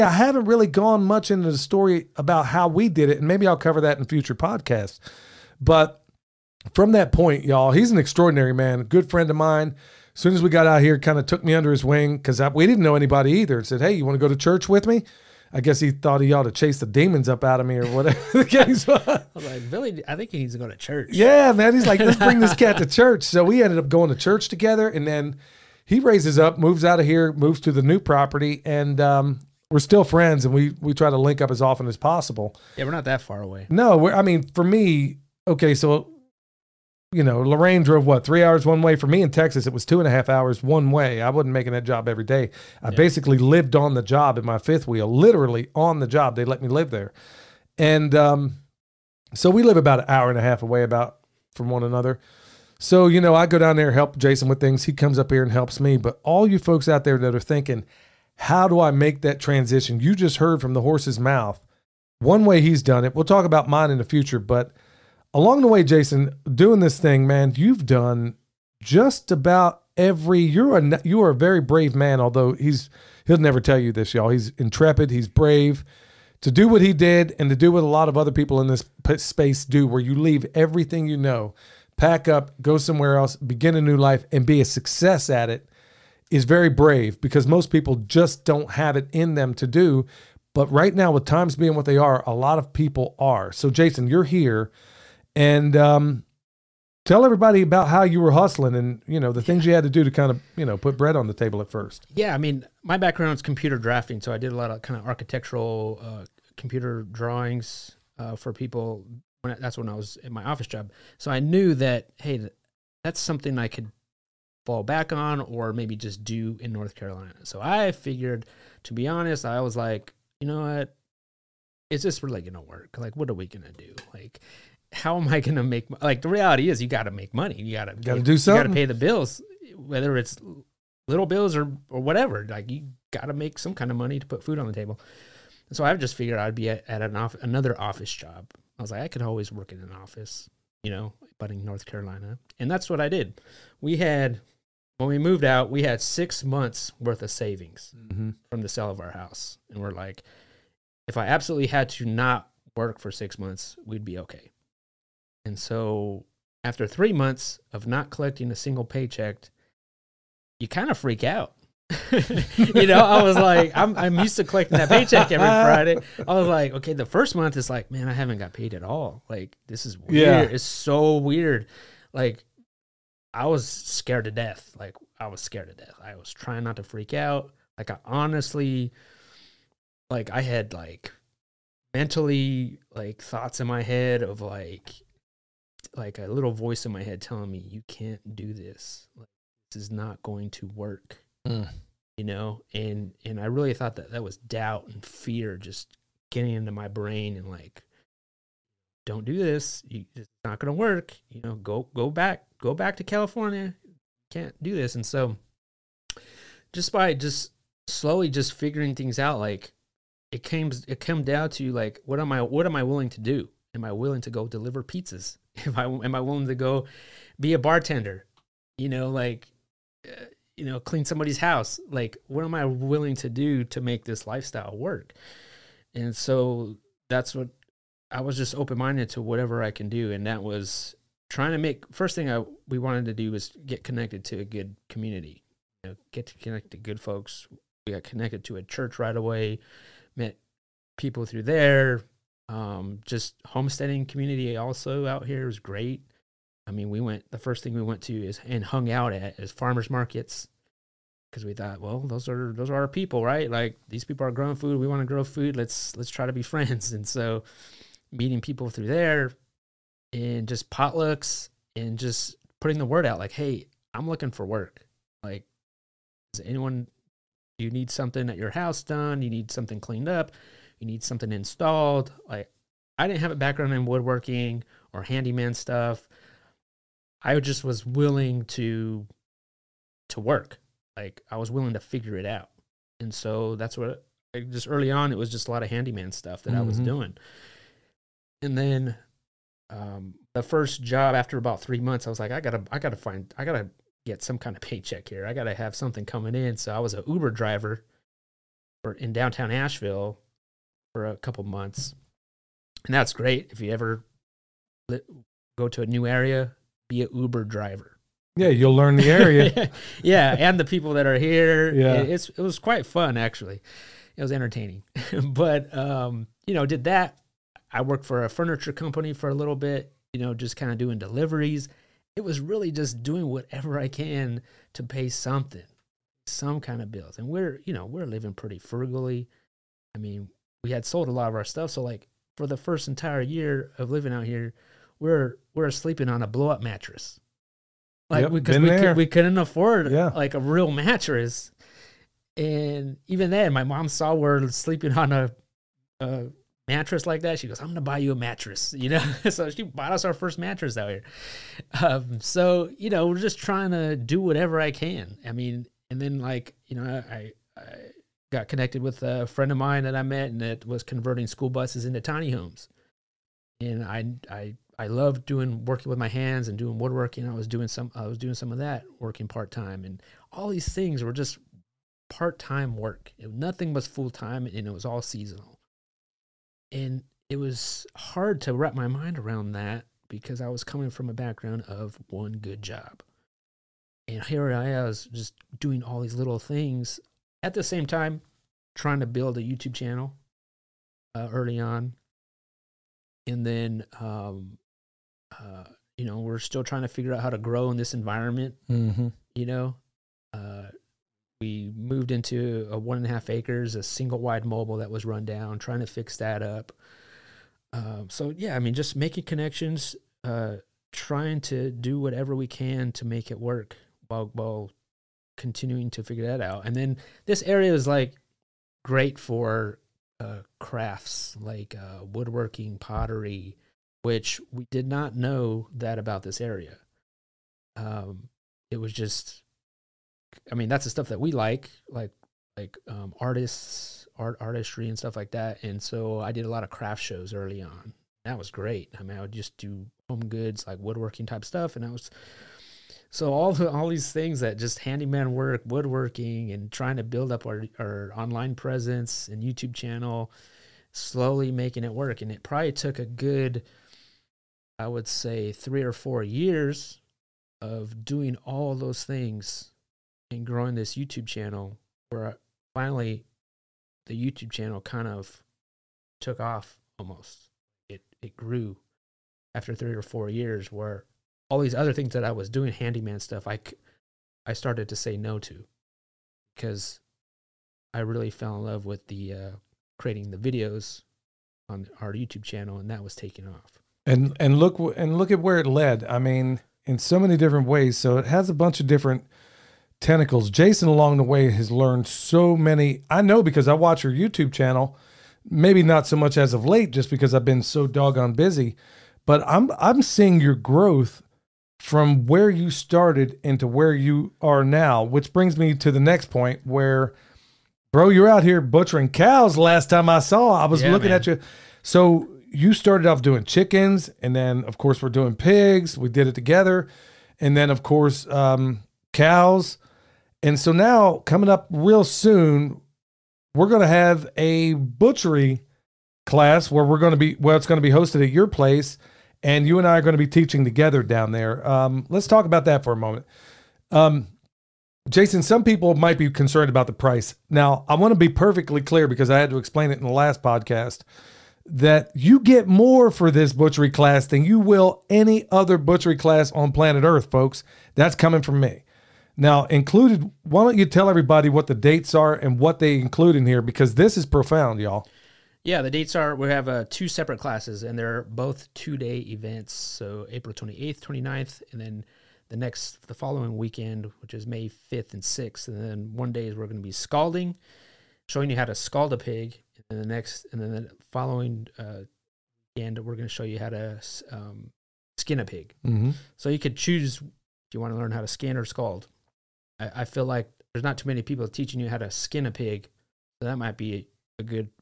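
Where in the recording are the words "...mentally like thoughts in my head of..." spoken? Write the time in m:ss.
3:01.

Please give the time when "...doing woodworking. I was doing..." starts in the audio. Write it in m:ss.
6:06.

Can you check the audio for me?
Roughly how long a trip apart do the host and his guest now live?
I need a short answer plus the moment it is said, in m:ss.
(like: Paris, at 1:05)
1.5 hours, at 0:49.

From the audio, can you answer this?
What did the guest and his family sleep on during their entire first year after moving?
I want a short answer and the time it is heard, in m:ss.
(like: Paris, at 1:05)
Blow up mattress, at 5:36.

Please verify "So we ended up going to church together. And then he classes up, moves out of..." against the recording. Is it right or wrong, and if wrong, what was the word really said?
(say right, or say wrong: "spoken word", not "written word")
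wrong: "raises", not "classes".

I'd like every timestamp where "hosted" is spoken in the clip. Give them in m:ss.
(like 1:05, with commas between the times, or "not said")
8:47.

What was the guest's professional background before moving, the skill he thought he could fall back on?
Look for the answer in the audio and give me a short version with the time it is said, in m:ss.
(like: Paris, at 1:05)
Computer drafting, at 1:43.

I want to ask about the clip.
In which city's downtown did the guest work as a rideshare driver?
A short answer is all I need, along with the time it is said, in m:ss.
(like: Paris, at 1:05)
Asheville, at 4:59.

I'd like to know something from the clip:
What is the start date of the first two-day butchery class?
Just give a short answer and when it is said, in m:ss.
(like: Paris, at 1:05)
April 28, at 9:20.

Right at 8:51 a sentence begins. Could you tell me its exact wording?
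Um, let's talk about that for a moment.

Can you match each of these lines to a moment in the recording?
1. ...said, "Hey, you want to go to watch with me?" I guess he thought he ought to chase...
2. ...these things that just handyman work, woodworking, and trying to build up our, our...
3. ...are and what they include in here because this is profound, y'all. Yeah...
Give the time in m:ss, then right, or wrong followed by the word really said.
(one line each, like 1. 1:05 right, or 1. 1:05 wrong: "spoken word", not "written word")
1. 0:13 wrong: "church", not "watch"
2. 7:23 right
3. 9:12 right.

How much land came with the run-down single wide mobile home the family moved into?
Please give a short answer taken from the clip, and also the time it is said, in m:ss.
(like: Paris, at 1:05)
1.5 acres, at 6:42.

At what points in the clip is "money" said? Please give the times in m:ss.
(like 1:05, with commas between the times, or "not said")
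2:07, 2:13.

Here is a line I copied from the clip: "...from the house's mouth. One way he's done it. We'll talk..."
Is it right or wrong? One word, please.
wrong.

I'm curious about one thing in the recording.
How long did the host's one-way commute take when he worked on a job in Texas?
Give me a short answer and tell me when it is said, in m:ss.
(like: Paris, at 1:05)
2.5 hours, at 0:39.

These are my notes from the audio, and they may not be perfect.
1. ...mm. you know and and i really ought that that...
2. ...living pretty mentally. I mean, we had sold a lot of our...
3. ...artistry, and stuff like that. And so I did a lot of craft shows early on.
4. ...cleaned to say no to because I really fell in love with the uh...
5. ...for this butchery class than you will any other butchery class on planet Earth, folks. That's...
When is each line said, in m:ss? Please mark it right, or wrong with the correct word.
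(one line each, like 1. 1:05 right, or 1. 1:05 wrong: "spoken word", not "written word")
1. 3:11 wrong: "thought", not "ought"
2. 5:28 wrong: "frugally", not "mentally"
3. 7:14 right
4. 7:54 wrong: "started", not "cleaned"
5. 9:03 right.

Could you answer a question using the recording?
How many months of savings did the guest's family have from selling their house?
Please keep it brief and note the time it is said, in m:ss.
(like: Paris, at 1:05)
6 months, at 2:25.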